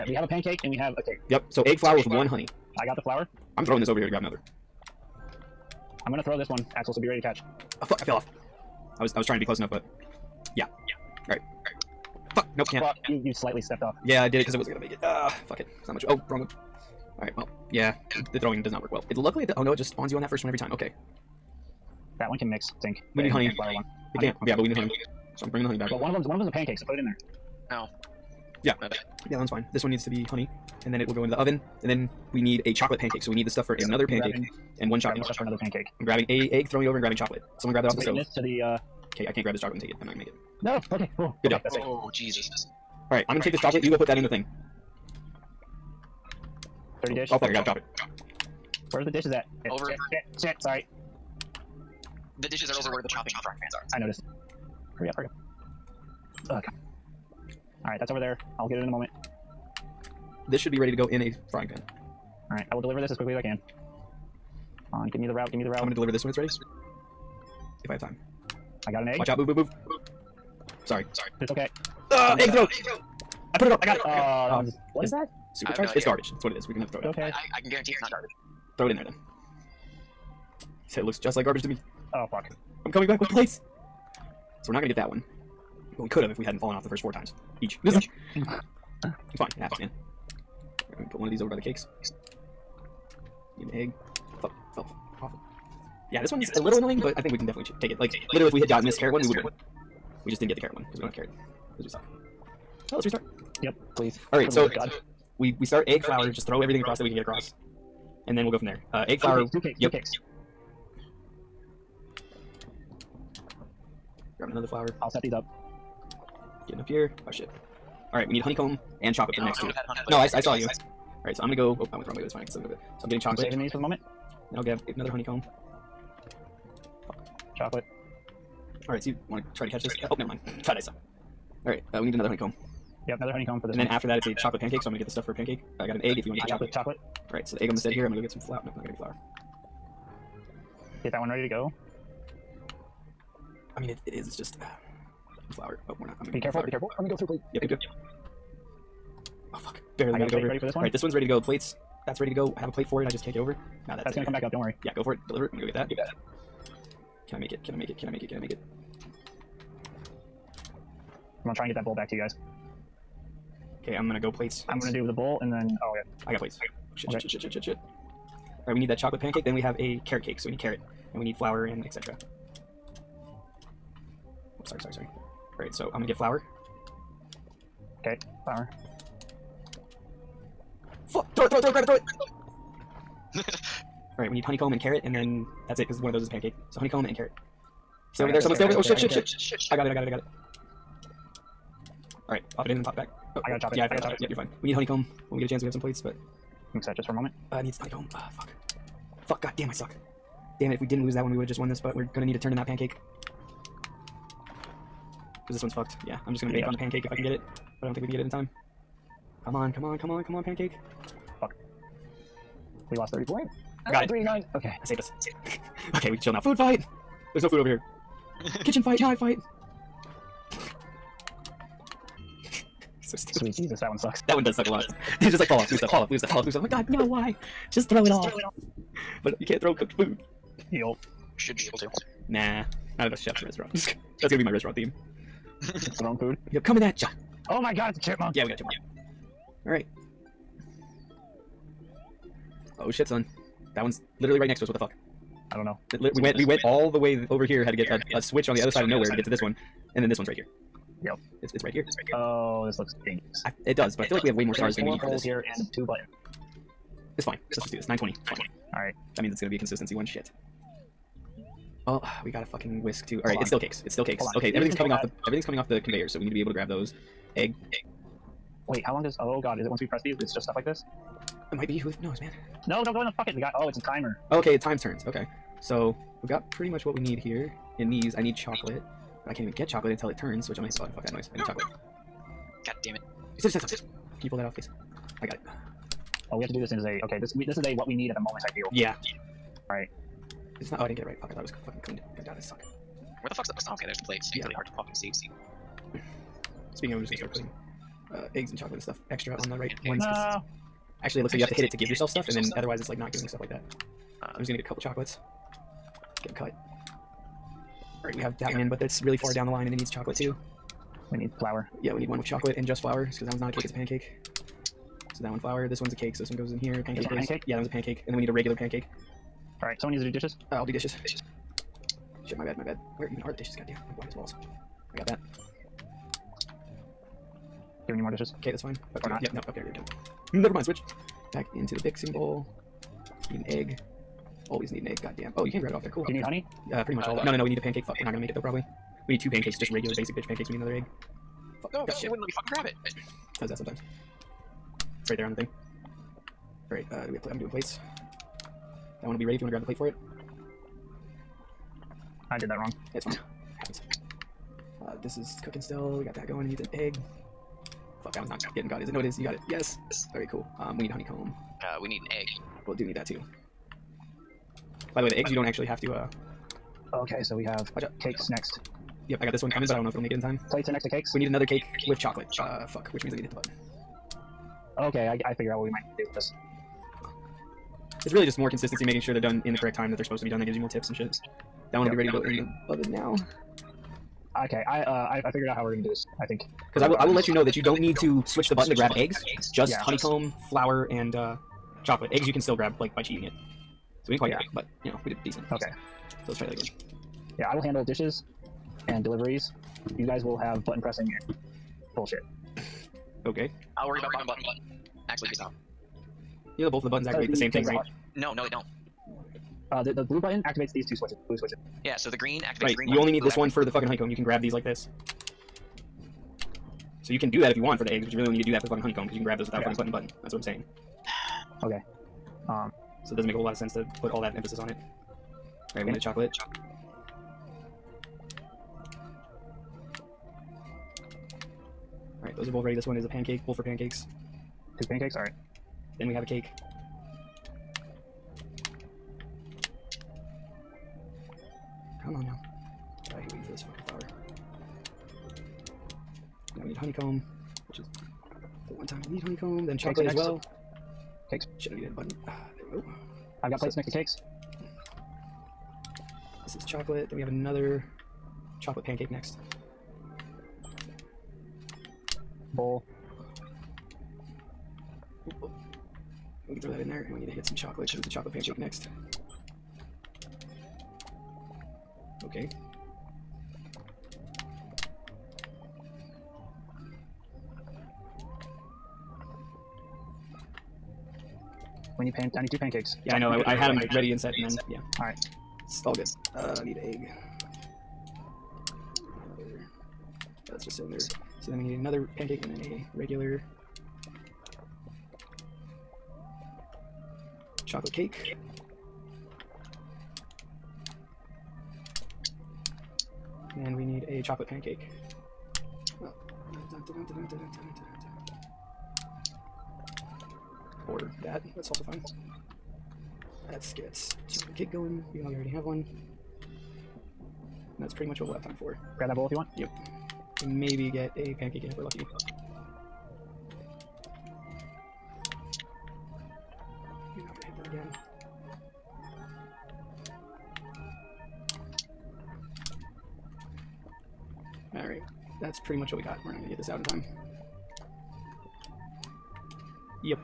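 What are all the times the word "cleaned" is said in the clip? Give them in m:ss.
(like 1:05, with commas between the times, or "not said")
4:51.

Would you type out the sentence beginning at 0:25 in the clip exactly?
So I'm bringing the honey back.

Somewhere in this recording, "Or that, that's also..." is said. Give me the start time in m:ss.
8:30.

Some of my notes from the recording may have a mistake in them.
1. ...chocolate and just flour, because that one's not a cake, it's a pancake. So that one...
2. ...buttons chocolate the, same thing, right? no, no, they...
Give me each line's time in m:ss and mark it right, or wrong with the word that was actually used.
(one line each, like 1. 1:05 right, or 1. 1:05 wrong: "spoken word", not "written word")
1. 5:12 right
2. 6:46 wrong: "activate", not "chocolate".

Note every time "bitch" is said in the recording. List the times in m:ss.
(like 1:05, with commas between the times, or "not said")
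5:40.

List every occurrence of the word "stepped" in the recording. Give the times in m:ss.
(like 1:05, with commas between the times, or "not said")
0:13.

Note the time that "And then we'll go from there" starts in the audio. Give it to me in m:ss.
1:48.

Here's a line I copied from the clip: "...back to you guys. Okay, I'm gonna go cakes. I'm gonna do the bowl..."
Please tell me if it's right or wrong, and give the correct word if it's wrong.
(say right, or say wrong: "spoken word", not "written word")
wrong: "plates", not "cakes".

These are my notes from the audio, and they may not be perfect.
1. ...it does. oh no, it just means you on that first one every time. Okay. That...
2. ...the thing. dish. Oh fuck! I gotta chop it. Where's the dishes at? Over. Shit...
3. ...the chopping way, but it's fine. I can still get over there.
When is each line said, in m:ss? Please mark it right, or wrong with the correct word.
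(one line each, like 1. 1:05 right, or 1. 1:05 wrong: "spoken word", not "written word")
1. 0:19 wrong: "spawns", not "means"
2. 0:44 right
3. 2:02 wrong: "wrong", not "chopping".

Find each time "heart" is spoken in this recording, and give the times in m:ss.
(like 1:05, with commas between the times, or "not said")
not said.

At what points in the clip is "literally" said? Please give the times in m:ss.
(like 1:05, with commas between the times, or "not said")
1:38, 4:04.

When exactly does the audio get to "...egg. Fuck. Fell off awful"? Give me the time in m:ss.
1:33.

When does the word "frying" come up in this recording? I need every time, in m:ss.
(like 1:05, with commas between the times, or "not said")
0:53, 1:01.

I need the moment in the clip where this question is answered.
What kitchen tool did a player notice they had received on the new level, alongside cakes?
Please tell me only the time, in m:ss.
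4:22.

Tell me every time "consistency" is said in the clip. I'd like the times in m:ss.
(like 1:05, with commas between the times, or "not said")
4:19, 6:18.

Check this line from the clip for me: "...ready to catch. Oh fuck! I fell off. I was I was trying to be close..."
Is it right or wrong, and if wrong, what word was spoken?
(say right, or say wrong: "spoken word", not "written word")
right.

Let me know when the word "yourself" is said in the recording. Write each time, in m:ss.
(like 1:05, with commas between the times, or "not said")
5:01.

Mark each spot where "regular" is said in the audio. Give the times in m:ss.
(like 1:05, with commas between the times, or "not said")
5:18, 5:39, 8:12.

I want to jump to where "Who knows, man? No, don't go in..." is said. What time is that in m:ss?
4:31.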